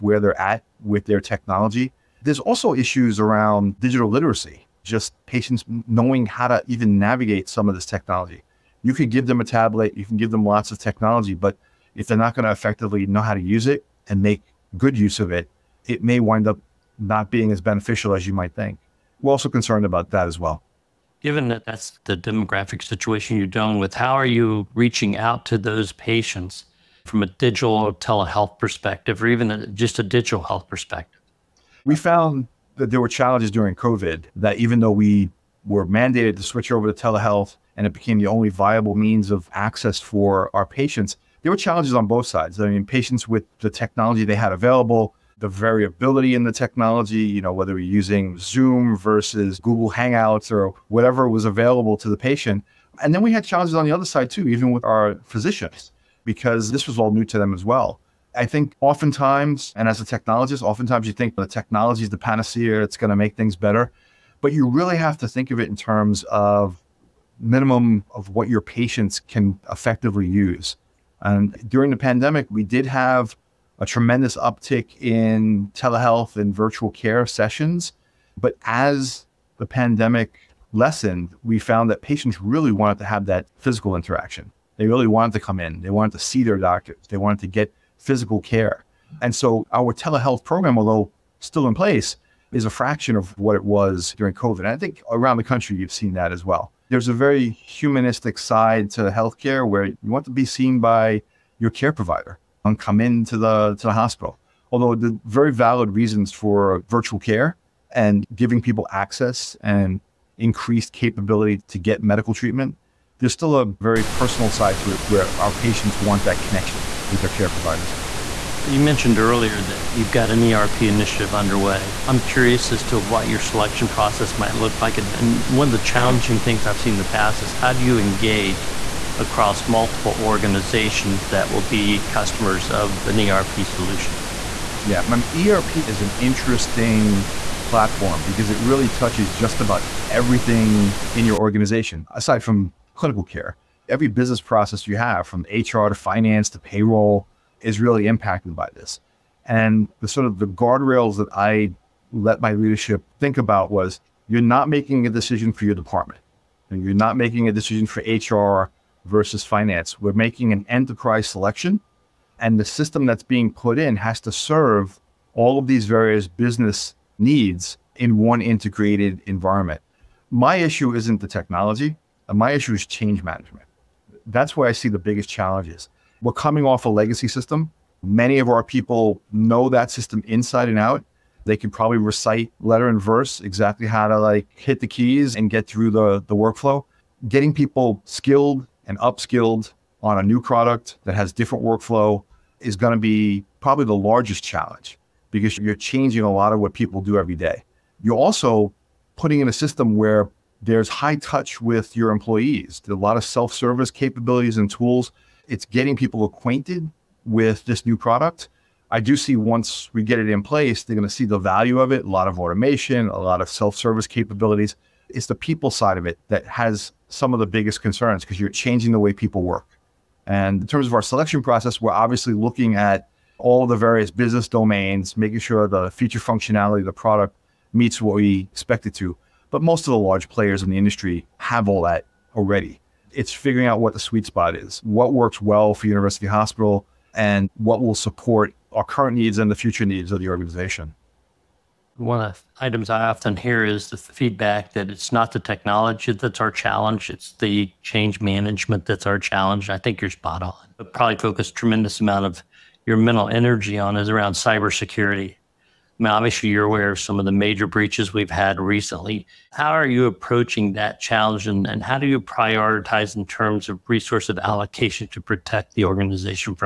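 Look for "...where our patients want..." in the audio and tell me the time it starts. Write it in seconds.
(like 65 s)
115 s.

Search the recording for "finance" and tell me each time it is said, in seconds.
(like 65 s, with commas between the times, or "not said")
145 s, 159 s.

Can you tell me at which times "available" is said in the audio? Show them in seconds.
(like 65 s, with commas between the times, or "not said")
44 s, 51 s.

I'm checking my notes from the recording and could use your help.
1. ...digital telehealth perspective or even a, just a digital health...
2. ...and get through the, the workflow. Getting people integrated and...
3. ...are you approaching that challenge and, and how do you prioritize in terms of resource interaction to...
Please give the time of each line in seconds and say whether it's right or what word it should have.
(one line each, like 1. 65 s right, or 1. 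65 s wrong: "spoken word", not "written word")
1. 27 s right
2. 185 s wrong: "skilled", not "integrated"
3. 259 s wrong: "allocation", not "interaction".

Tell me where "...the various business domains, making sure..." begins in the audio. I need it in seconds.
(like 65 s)
223 s.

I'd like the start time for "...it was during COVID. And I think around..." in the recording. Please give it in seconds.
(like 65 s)
93 s.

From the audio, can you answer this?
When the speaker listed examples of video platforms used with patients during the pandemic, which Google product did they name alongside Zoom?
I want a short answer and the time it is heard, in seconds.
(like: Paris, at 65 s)
Google Hangouts, at 49 s.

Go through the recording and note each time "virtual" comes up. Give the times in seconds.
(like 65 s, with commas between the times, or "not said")
76 s, 106 s.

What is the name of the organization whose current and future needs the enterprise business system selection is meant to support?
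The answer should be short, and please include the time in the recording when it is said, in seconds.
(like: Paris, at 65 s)
University Hospital, at 235 s.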